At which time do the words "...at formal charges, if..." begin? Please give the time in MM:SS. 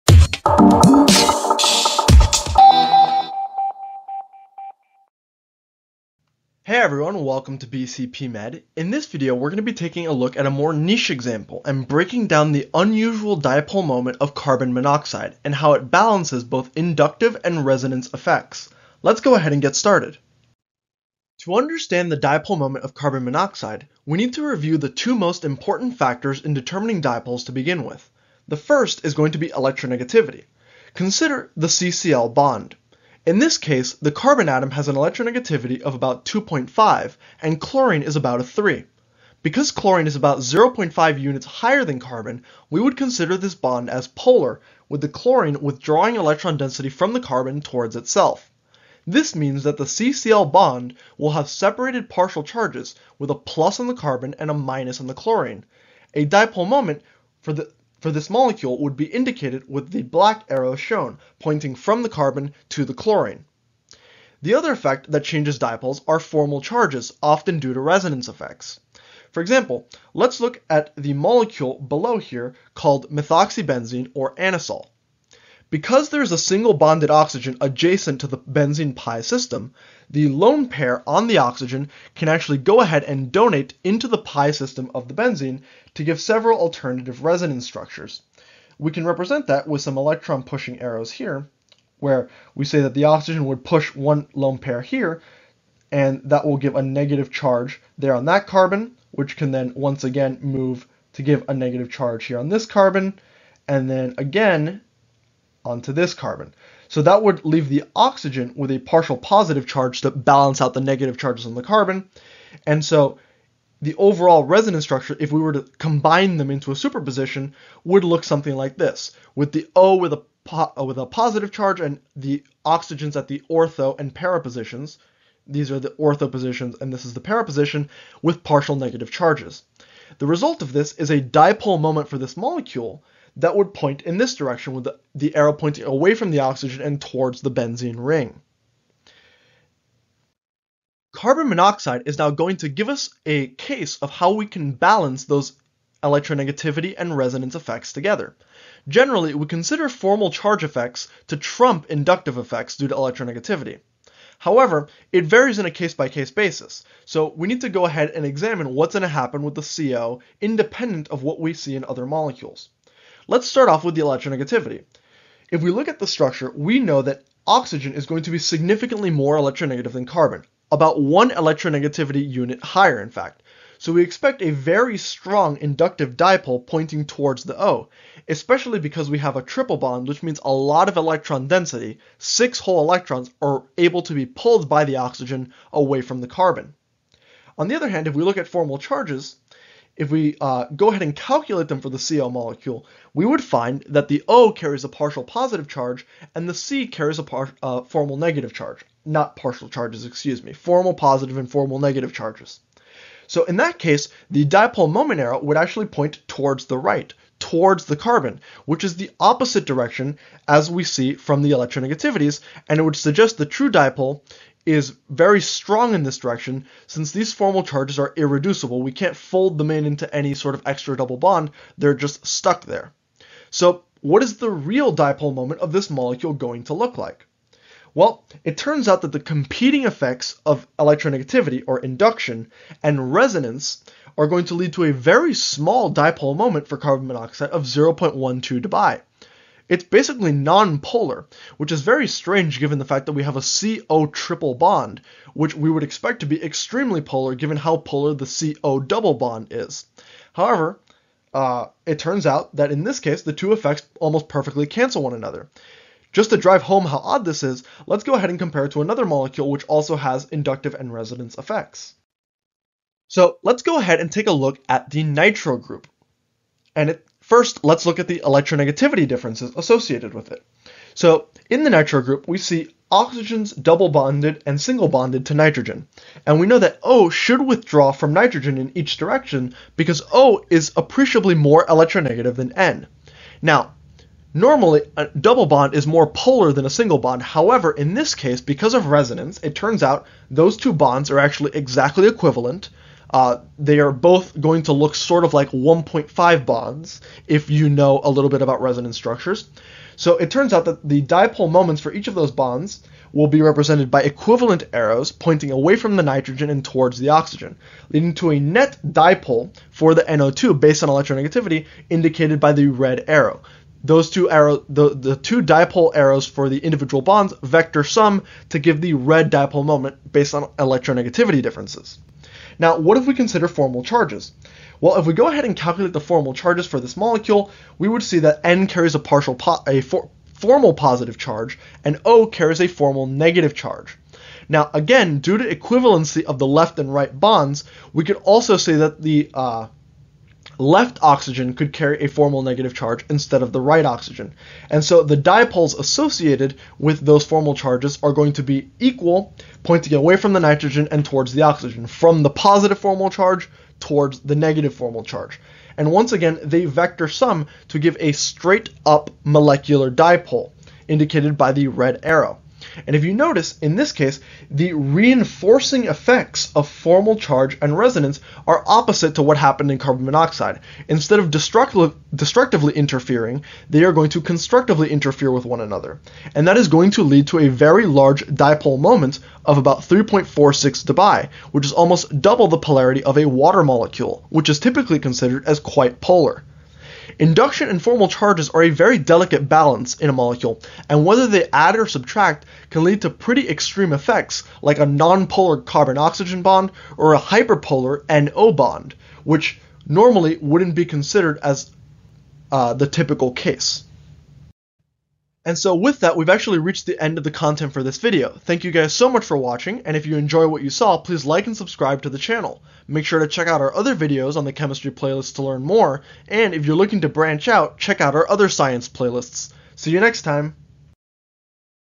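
03:08.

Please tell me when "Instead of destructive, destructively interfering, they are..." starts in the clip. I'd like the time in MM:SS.
06:10.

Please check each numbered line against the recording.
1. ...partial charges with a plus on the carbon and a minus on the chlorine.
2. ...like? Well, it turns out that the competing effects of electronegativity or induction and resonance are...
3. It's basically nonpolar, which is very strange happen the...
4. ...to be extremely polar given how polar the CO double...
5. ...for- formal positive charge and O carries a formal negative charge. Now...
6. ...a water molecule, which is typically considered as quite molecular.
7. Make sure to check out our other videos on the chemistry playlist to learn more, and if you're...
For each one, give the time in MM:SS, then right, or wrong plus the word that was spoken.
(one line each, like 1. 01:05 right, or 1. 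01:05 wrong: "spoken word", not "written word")
1. 00:52 right
2. 03:46 right
3. 03:59 wrong: "given", not "happen"
4. 04:06 right
5. 05:29 right
6. 06:23 wrong: "polar", not "molecular"
7. 06:52 right.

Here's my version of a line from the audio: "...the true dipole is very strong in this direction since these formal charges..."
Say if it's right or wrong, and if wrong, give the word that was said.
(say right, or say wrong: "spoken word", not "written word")
right.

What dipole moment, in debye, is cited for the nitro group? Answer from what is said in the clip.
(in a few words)
3.46 debye.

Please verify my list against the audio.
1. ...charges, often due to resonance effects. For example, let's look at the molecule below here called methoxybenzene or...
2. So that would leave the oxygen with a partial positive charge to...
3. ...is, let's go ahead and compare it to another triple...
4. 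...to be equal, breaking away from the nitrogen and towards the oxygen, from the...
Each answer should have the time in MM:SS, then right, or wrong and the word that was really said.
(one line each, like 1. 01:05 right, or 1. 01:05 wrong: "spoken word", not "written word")
1. 01:06 right
2. 01:46 right
3. 04:17 wrong: "molecule", not "triple"
4. 05:48 wrong: "pointing", not "breaking".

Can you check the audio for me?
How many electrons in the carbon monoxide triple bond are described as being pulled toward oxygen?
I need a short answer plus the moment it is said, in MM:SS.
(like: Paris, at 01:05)
6, at 03:02.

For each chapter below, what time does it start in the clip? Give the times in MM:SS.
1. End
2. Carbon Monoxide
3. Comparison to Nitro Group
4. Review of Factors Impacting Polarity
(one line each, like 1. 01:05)
1. 06:46
2. 02:21
3. 04:26
4. 00:22.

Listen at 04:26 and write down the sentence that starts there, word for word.
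And it First, let's look at the electronegativity differences associated with it.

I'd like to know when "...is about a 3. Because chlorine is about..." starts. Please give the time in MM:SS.
00:38.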